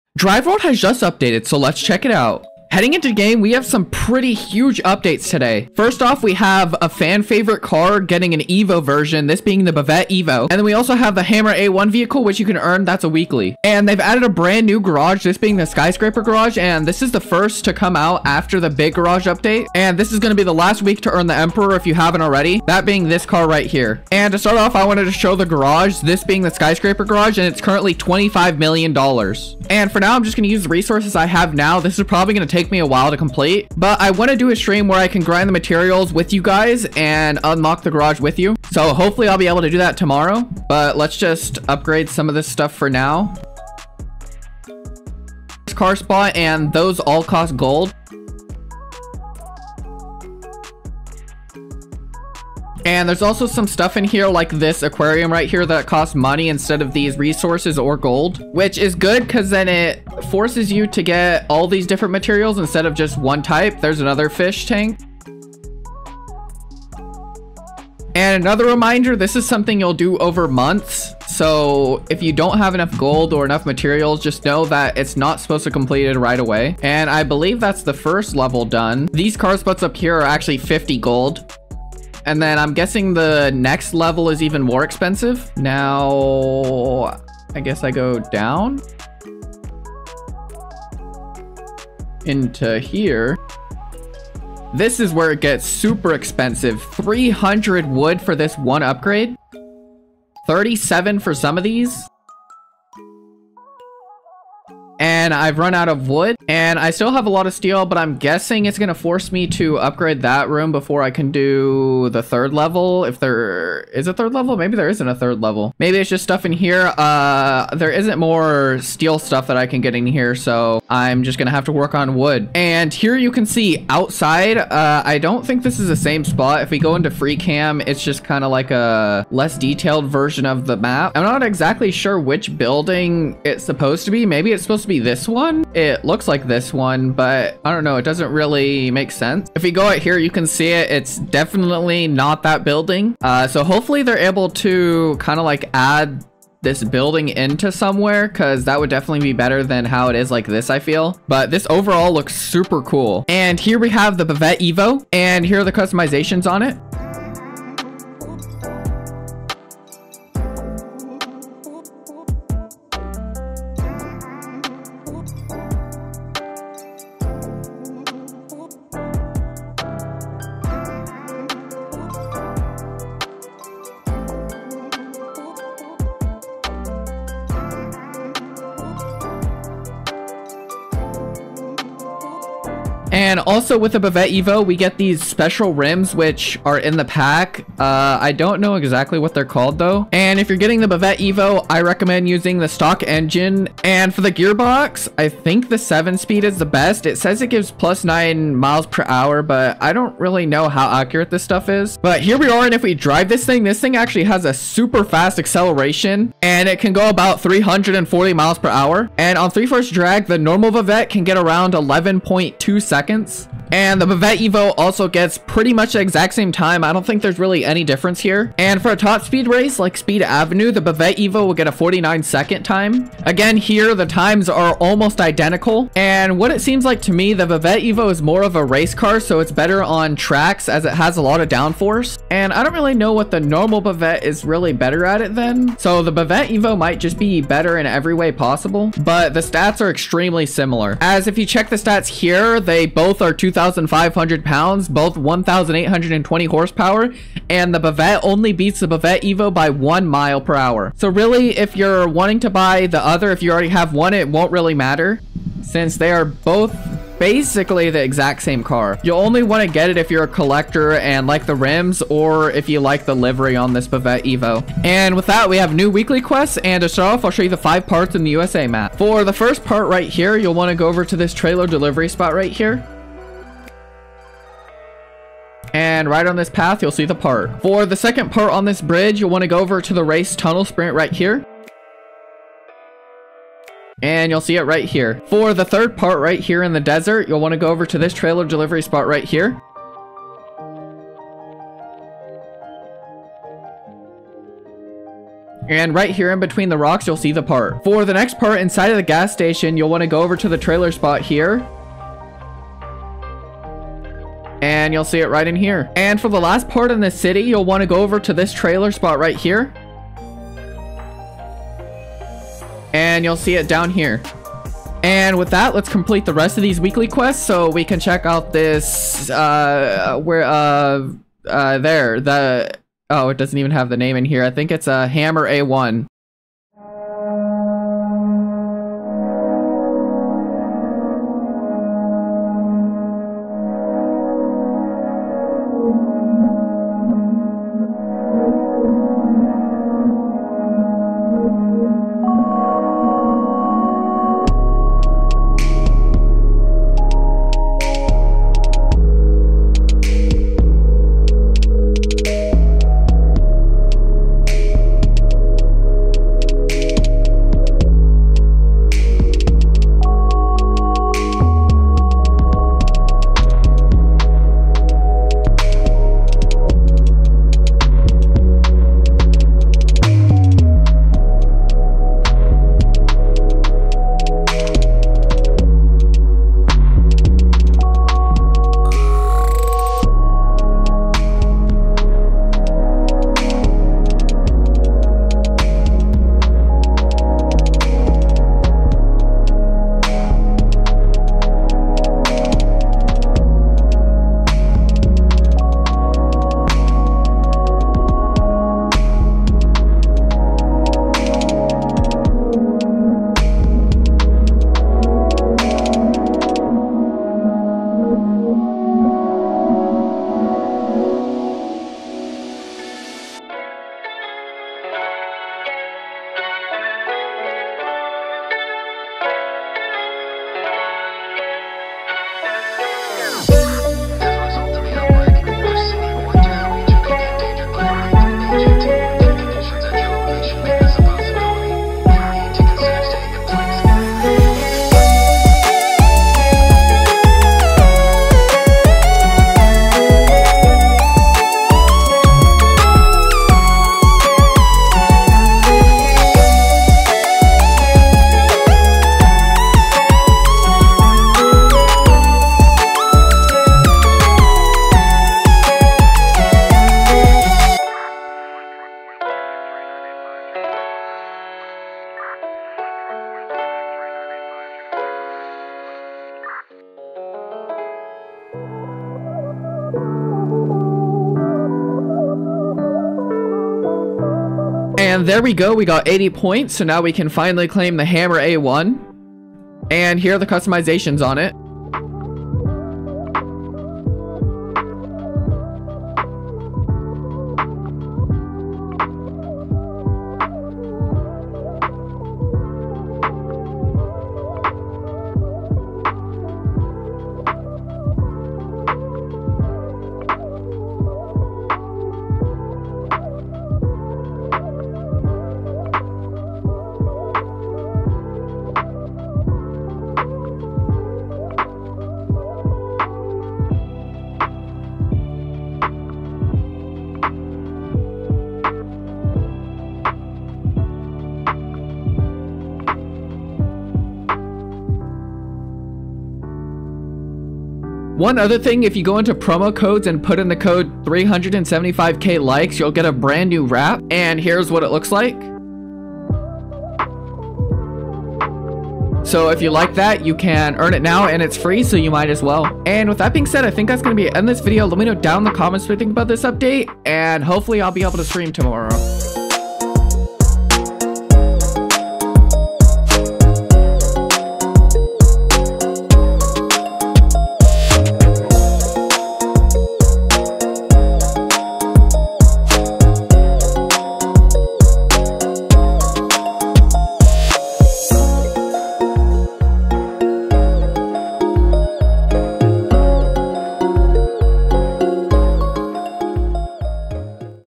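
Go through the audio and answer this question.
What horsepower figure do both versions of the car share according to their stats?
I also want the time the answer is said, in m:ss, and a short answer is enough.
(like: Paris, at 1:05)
1,820, at 4:05.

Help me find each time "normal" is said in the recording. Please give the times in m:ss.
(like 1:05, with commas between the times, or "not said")
3:30, 3:53.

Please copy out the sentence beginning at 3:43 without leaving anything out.
Again, here the times are almost identical.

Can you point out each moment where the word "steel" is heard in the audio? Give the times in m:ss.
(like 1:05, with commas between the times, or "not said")
1:47, 1:58.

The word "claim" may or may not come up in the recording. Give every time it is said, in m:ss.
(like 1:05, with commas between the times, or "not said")
7:57.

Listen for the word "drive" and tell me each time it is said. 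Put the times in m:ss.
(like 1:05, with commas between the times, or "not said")
0:00, 3:22.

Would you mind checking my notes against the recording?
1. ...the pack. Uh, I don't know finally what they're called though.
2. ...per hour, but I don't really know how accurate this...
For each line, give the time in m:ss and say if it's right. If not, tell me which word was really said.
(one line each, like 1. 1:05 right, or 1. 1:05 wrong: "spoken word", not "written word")
1. 3:06 wrong: "exactly", not "finally"
2. 3:18 right.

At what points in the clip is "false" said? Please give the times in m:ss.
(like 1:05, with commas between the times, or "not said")
not said.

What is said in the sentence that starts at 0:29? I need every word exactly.
And for now, I'm just gonna use the resources I have now.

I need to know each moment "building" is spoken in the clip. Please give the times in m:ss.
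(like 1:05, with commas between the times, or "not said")
2:12, 2:22, 2:26.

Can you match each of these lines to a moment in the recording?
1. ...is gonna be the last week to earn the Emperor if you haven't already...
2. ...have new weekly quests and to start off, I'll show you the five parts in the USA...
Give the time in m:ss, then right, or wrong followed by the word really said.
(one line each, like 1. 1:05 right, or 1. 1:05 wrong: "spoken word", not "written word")
1. 0:20 right
2. 4:25 right.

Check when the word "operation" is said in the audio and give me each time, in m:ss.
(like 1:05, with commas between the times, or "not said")
not said.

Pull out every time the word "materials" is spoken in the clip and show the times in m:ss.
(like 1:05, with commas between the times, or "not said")
0:35, 1:02, 1:13.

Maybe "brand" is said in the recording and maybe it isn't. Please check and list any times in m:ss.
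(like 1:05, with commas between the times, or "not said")
0:14, 8:53.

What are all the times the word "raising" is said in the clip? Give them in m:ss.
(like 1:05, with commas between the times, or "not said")
not said.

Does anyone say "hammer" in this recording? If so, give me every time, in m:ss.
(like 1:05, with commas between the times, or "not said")
0:11, 5:25, 7:58.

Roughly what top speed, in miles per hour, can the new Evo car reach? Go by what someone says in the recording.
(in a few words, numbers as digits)
340 mph.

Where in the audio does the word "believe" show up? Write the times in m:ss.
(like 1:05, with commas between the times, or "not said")
1:17.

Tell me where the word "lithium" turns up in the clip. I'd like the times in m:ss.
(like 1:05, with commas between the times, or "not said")
not said.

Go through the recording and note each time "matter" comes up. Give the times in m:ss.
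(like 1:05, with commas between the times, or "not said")
4:14.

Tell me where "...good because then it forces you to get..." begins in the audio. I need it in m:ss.
0:58.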